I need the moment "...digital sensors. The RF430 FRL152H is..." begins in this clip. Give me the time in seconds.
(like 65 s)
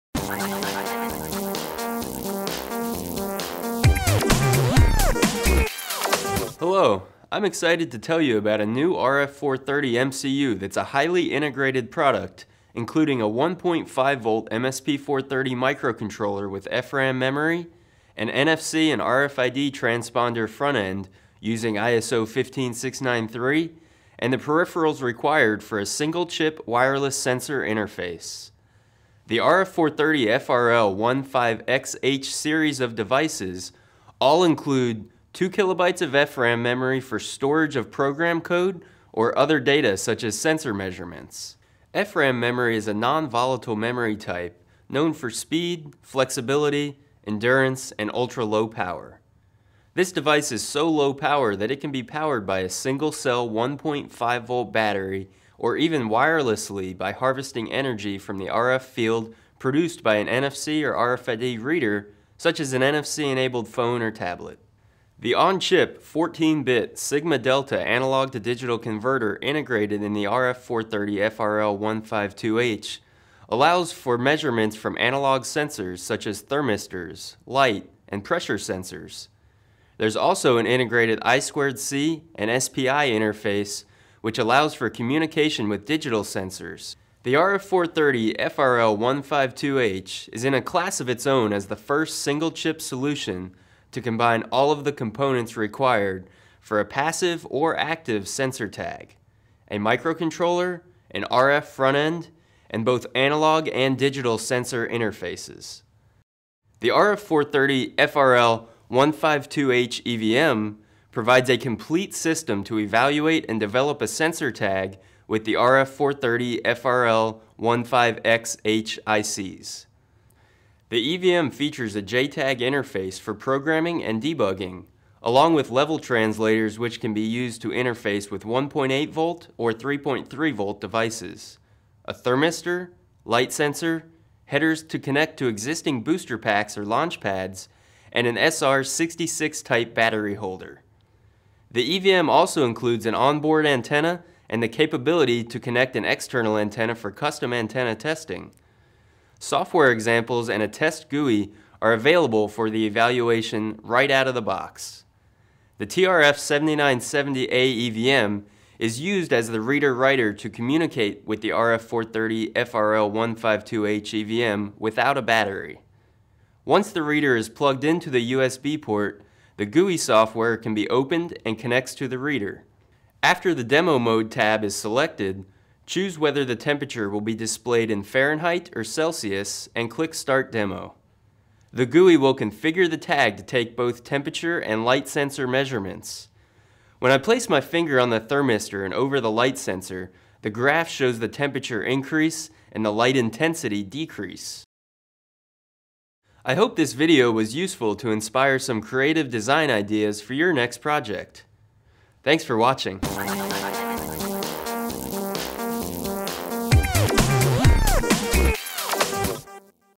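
85 s.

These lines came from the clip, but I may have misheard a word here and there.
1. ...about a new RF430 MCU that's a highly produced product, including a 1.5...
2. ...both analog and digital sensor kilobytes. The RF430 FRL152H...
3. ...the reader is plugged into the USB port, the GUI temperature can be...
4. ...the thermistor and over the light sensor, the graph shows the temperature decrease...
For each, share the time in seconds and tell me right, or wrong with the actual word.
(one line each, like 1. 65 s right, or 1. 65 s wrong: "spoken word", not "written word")
1. 8 s wrong: "integrated", not "produced"
2. 102 s wrong: "interfaces", not "kilobytes"
3. 166 s wrong: "software", not "temperature"
4. 188 s wrong: "increase", not "decrease".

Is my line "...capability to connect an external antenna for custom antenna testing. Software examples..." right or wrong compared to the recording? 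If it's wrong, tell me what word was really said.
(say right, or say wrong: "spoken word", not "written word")
right.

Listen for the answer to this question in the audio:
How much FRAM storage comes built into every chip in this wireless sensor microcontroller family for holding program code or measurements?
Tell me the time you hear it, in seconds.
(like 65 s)
35 s.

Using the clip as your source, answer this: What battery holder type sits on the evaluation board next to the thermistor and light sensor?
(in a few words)
SR66.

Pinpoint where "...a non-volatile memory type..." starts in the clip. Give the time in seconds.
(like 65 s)
42 s.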